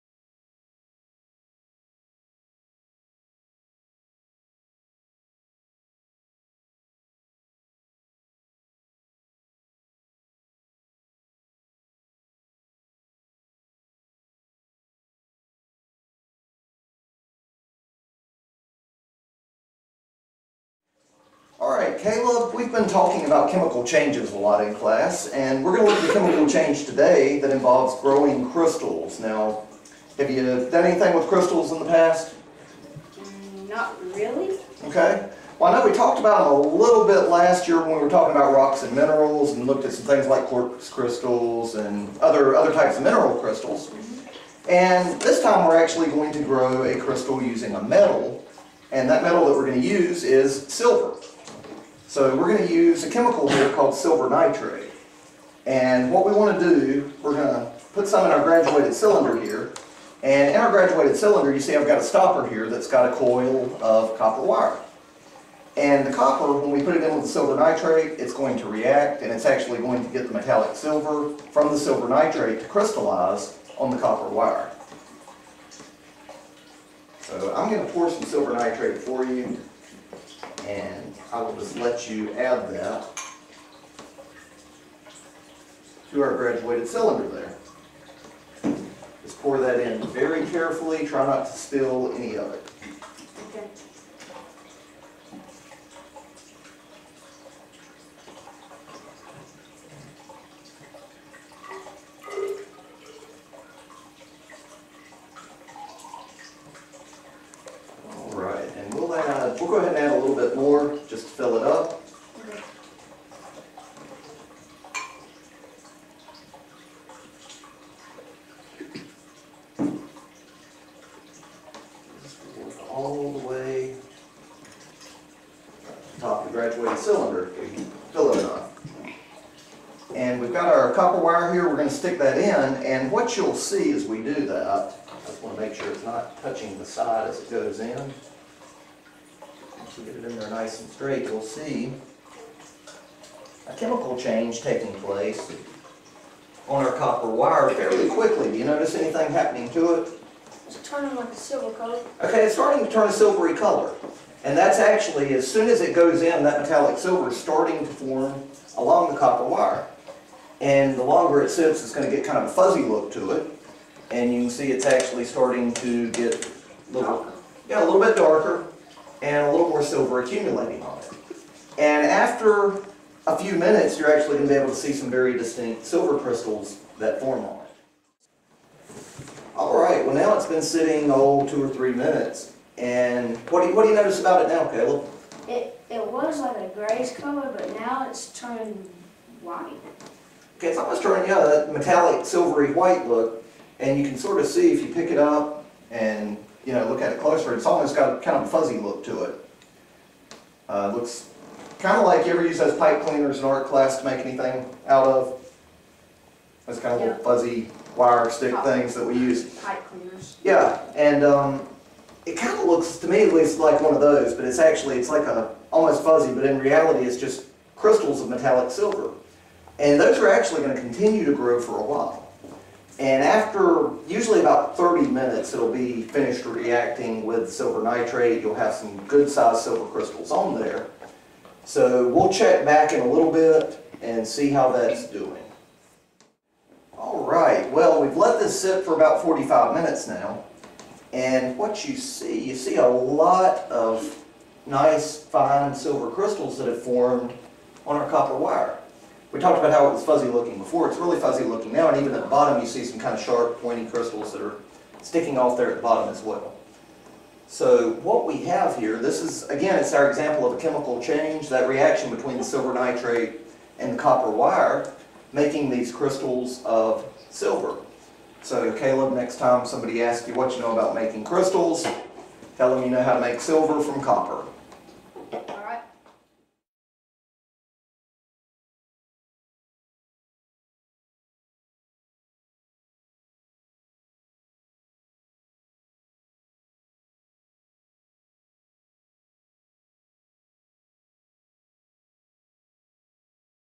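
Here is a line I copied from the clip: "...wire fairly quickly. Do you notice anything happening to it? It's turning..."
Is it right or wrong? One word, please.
right.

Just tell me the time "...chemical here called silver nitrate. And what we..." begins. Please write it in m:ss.
0:53.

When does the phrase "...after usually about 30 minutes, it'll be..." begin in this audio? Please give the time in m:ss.
3:43.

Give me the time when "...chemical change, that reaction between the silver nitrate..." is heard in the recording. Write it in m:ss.
4:20.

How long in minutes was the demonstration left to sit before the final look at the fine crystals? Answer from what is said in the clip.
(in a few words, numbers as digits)
45.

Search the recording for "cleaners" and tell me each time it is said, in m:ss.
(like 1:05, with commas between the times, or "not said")
3:23, 3:29.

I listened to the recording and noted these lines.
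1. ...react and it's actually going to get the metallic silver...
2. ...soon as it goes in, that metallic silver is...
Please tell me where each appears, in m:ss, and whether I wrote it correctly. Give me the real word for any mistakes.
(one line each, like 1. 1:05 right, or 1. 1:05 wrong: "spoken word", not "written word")
1. 1:08 right
2. 2:35 right.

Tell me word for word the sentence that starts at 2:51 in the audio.
And after a few minutes, you're actually going to be able to see some very distinct silver crystals that form on it.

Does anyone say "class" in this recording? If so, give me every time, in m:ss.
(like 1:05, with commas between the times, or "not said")
0:24, 3:23.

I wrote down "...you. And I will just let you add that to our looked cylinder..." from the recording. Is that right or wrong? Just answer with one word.
wrong.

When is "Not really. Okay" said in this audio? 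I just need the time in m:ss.
0:33.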